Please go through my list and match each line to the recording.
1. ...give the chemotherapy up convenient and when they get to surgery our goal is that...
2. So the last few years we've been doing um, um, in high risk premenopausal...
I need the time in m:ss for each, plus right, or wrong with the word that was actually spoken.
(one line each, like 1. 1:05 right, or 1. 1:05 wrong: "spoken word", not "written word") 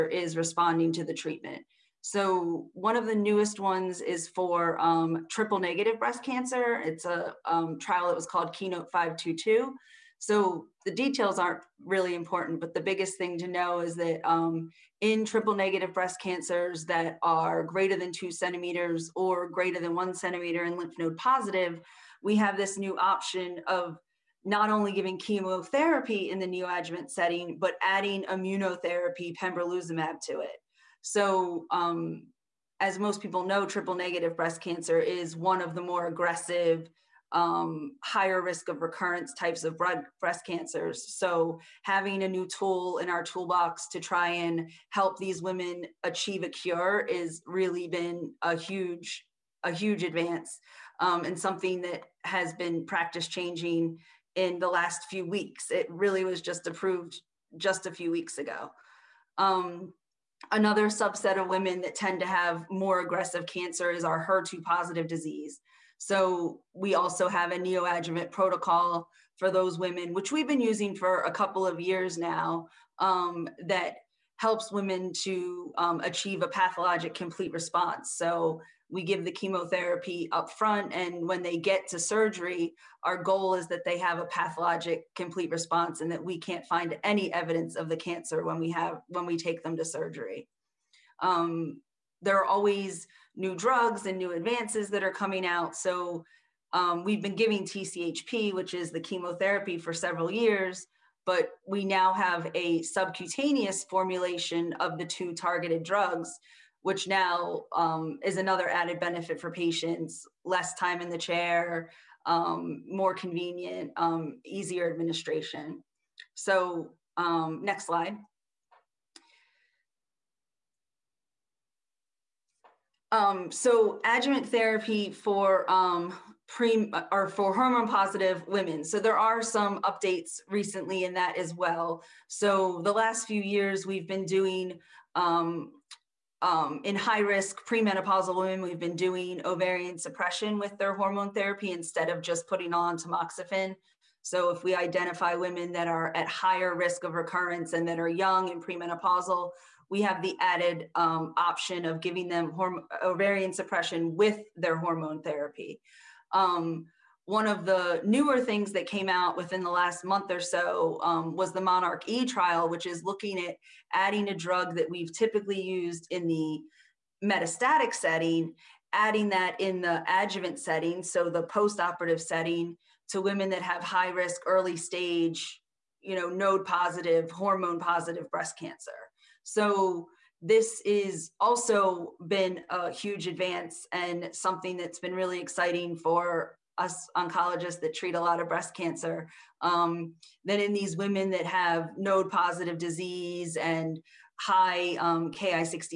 1. 1:19 wrong: "front", not "convenient"
2. 2:12 right.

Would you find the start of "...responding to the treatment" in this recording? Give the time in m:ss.
0:00.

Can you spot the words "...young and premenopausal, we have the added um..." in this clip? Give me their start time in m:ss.
2:28.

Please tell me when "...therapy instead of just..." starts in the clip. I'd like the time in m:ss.
2:21.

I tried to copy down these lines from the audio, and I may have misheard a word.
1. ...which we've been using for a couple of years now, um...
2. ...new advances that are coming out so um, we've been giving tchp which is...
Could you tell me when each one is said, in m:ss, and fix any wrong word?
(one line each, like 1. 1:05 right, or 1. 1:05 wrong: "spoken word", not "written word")
1. 1:10 right
2. 1:34 right.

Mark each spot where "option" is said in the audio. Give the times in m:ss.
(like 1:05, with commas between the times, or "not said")
0:22, 2:31.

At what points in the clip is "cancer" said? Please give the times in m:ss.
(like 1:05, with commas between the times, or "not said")
0:06, 0:16, 0:34, 0:40, 1:03, 1:27, 2:58, 3:08.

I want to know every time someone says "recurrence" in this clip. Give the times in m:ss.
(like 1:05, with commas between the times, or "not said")
0:38, 2:27.